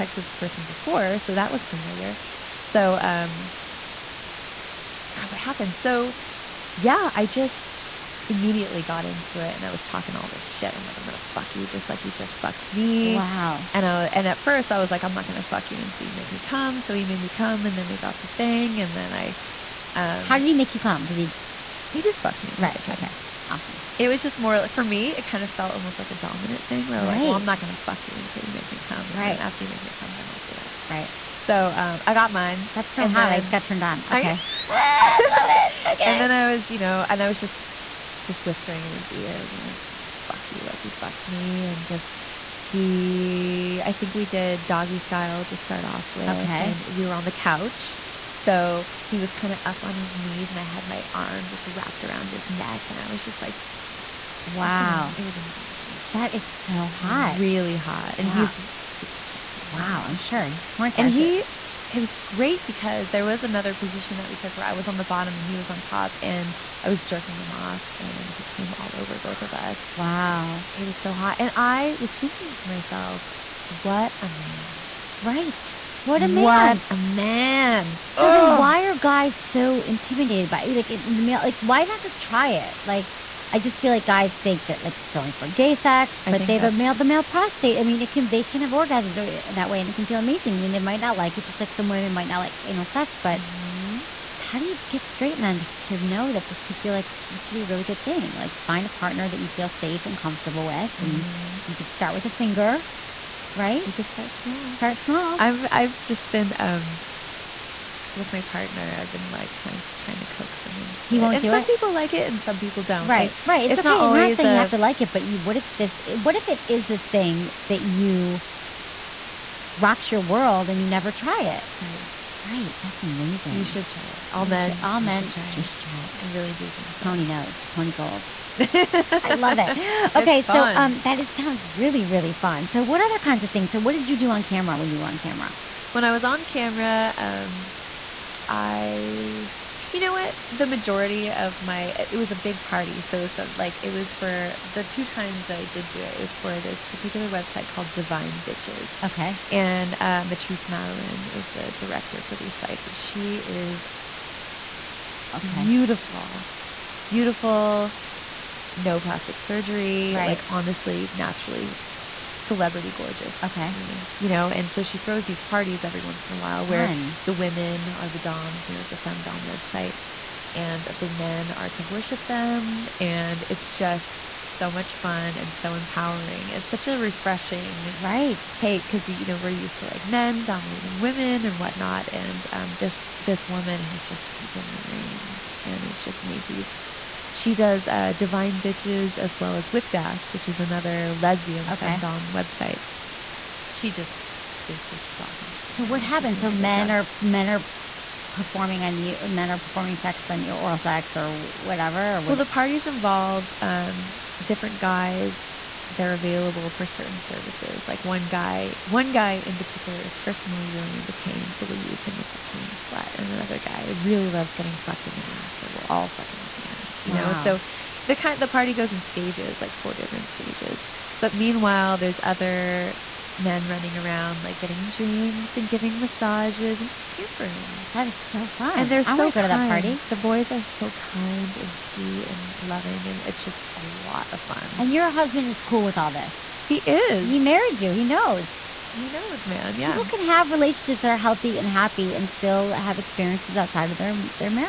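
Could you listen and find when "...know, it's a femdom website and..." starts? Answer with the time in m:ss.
2:48.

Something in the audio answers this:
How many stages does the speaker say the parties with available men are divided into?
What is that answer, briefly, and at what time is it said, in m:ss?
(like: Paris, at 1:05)
4, at 3:39.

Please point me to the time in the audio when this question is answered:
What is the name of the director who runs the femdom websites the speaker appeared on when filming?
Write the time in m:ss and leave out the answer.
2:30.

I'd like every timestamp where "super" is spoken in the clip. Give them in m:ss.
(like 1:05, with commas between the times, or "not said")
0:58.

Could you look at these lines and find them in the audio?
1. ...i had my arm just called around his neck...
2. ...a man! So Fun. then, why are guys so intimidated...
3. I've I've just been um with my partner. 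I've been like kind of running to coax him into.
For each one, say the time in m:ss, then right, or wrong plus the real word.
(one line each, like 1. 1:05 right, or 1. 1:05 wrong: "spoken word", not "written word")
1. 0:50 wrong: "wrapped", not "called"
2. 1:16 wrong: "Ugh", not "Fun"
3. 1:45 wrong: "trying", not "running".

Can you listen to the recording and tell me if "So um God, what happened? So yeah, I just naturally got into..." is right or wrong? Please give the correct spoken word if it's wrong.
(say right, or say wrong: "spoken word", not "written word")
wrong: "immediately", not "naturally".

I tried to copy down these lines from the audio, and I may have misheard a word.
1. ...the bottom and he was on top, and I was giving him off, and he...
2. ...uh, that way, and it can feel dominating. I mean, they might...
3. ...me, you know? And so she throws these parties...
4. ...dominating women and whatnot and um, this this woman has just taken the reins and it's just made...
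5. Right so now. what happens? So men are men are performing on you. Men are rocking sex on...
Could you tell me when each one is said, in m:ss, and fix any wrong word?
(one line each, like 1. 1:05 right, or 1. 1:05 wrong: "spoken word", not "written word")
1. 1:04 wrong: "jerking", not "giving"
2. 1:29 wrong: "amazing", not "dominating"
3. 2:43 right
4. 3:00 right
5. 3:15 wrong: "performing", not "rocking".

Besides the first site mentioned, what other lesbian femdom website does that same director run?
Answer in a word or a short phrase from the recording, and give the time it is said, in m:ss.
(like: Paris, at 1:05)
Whipped Ass, at 3:09.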